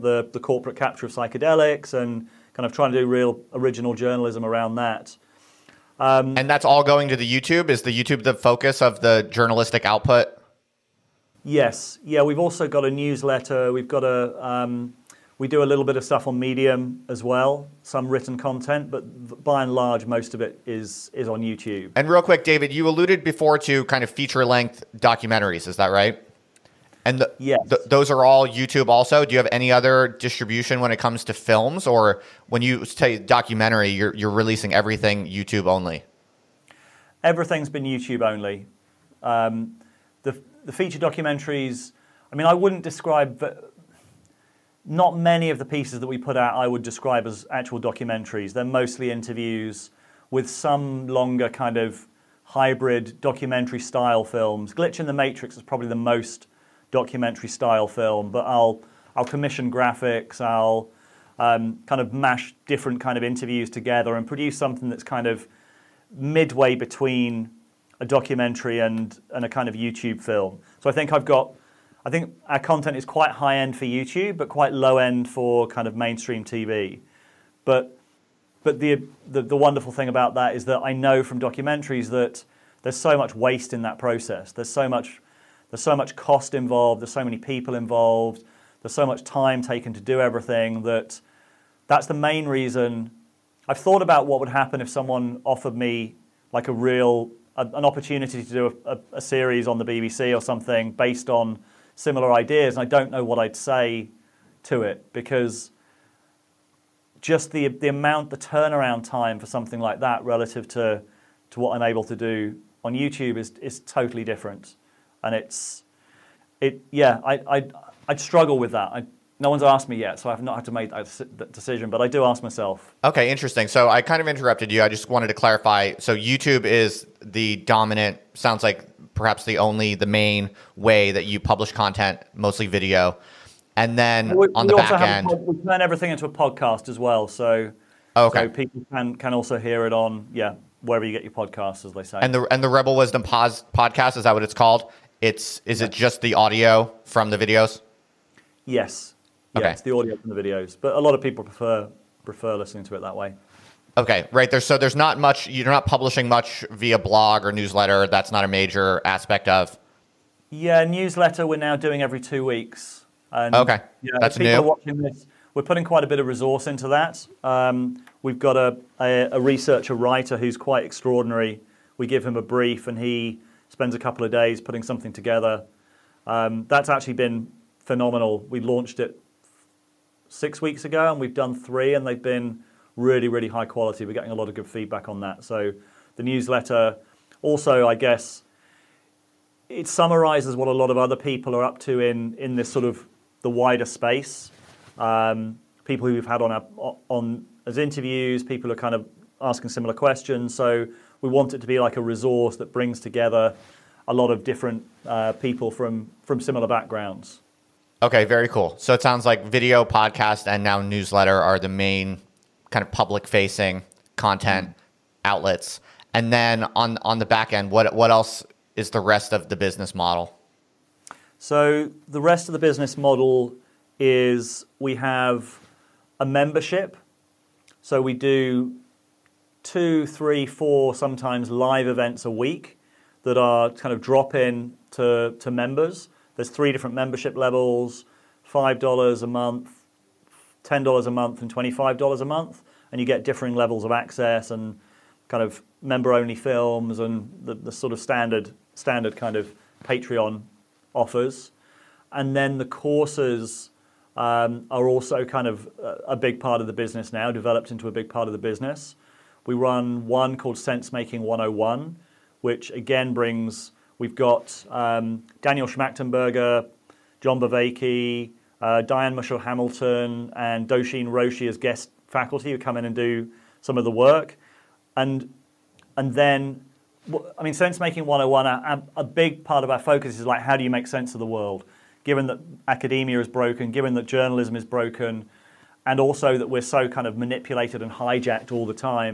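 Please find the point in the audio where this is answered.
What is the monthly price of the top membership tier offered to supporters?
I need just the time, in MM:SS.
04:01.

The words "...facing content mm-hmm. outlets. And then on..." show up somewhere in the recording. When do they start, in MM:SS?
03:33.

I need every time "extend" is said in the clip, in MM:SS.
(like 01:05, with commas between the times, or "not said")
not said.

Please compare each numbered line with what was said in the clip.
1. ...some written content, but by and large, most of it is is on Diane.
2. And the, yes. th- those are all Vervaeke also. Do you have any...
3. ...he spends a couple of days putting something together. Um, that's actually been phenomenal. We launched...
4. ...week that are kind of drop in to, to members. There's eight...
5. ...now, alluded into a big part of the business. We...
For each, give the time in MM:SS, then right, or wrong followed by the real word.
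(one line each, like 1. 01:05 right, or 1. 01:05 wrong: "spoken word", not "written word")
1. 00:17 wrong: "YouTube", not "Diane"
2. 00:27 wrong: "YouTube", not "Vervaeke"
3. 02:52 right
4. 03:52 wrong: "three", not "eight"
5. 04:17 wrong: "developed", not "alluded".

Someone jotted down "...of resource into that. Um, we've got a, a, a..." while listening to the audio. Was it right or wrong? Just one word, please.
right.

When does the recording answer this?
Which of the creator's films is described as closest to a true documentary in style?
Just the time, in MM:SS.
00:54.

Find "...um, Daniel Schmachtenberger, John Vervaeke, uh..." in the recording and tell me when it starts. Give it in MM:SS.
04:24.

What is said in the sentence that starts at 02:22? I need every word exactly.
And the and the Rebel Wisdom Pos- podcast is that what it's called?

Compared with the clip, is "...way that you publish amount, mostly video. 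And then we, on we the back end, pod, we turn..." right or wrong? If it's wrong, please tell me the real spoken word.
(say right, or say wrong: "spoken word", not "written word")
wrong: "content", not "amount".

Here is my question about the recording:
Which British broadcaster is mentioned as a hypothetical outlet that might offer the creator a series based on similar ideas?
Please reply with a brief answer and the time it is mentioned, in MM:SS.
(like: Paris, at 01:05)
BBC, at 01:39.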